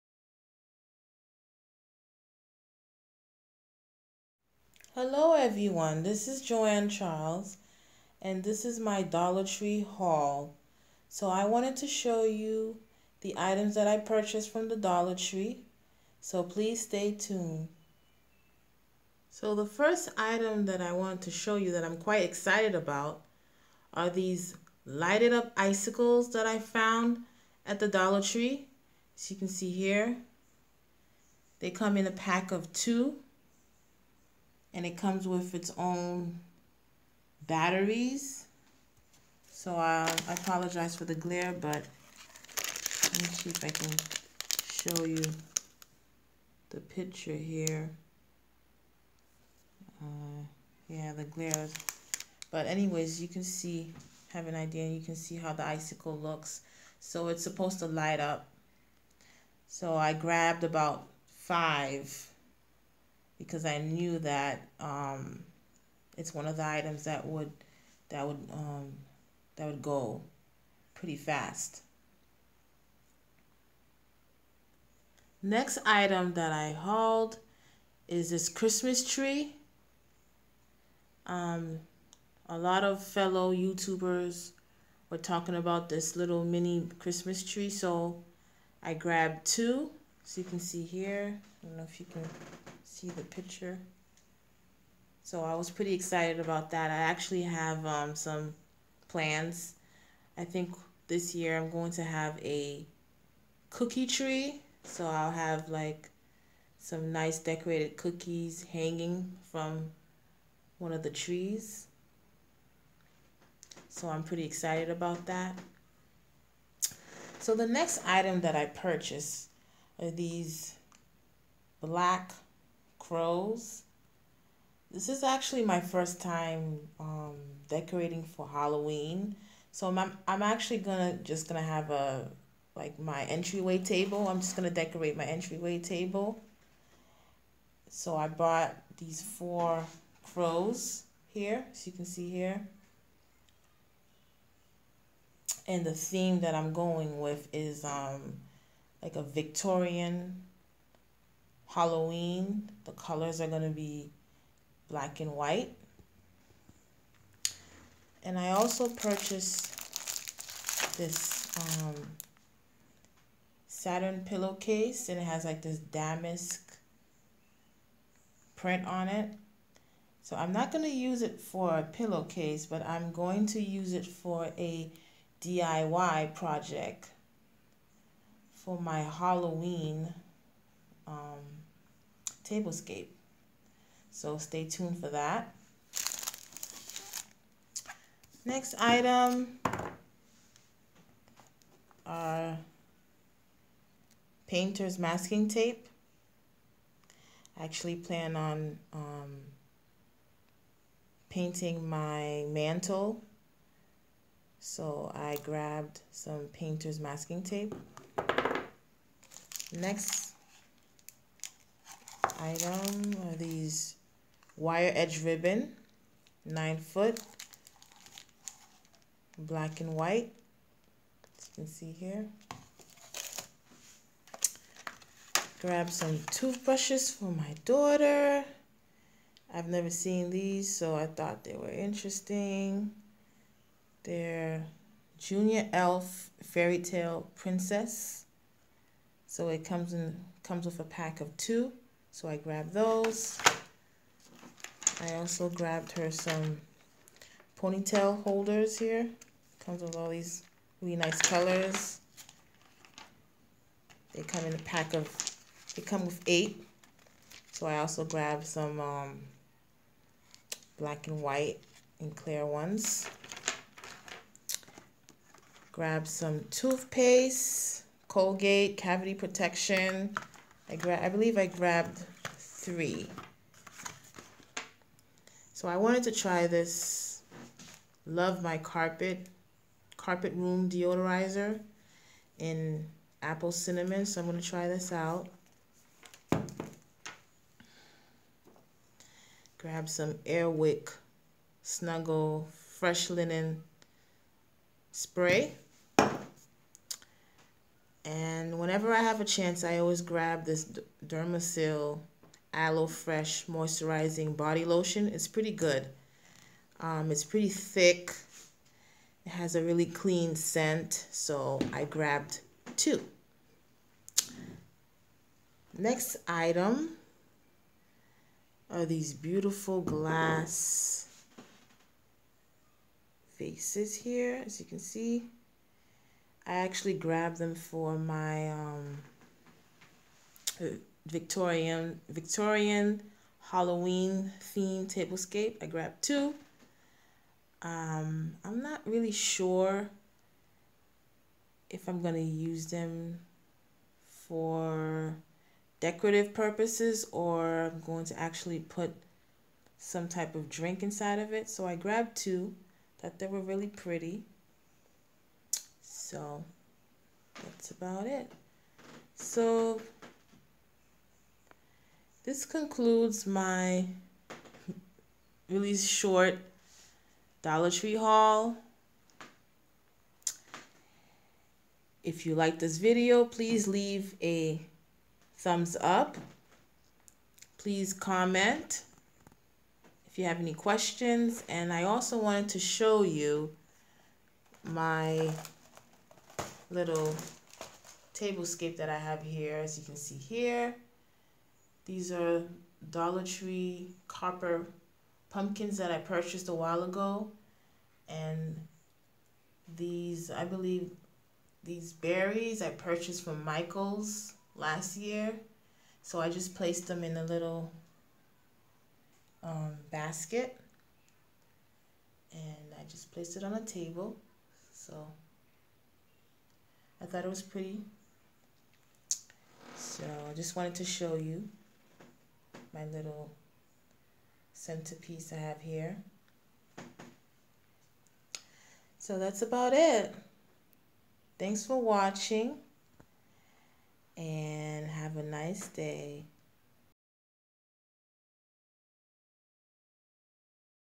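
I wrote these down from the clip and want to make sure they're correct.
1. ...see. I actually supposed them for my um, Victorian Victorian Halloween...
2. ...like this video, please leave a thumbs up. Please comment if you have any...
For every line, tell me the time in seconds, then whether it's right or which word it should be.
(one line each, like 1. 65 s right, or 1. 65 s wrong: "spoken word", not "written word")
1. 324 s wrong: "grabbed", not "supposed"
2. 372 s right.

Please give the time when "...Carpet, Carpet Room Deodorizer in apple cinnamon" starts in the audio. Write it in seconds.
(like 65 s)
278 s.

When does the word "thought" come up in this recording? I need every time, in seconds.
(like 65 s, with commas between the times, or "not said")
231 s, 352 s, 417 s.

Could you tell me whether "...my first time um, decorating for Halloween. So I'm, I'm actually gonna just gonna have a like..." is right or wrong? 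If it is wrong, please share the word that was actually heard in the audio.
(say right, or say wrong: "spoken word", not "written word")
right.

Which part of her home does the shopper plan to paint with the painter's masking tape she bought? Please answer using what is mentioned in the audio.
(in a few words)
mantle.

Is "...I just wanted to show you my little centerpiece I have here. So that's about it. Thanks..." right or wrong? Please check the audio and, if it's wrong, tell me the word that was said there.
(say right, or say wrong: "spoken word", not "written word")
right.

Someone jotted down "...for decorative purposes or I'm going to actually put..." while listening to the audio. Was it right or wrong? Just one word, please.
right.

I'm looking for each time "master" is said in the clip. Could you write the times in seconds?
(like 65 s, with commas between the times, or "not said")
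not said.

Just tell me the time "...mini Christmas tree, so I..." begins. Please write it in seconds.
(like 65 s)
86 s.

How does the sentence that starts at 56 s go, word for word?
So it's supposed to light up.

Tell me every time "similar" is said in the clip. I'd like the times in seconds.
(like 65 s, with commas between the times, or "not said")
not said.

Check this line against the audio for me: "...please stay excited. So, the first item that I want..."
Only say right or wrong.
wrong.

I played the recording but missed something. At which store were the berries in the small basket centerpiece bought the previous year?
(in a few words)
Michael's.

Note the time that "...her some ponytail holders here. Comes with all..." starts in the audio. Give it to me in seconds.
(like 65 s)
245 s.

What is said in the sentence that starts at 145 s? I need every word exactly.
And the theme that I'm going with is um, like a Victorian Halloween.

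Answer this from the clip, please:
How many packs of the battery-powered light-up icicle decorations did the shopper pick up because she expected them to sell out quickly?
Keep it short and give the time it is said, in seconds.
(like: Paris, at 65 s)
5, at 61 s.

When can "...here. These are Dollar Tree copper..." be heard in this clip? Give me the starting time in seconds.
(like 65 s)
390 s.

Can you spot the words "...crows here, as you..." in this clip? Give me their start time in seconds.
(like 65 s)
140 s.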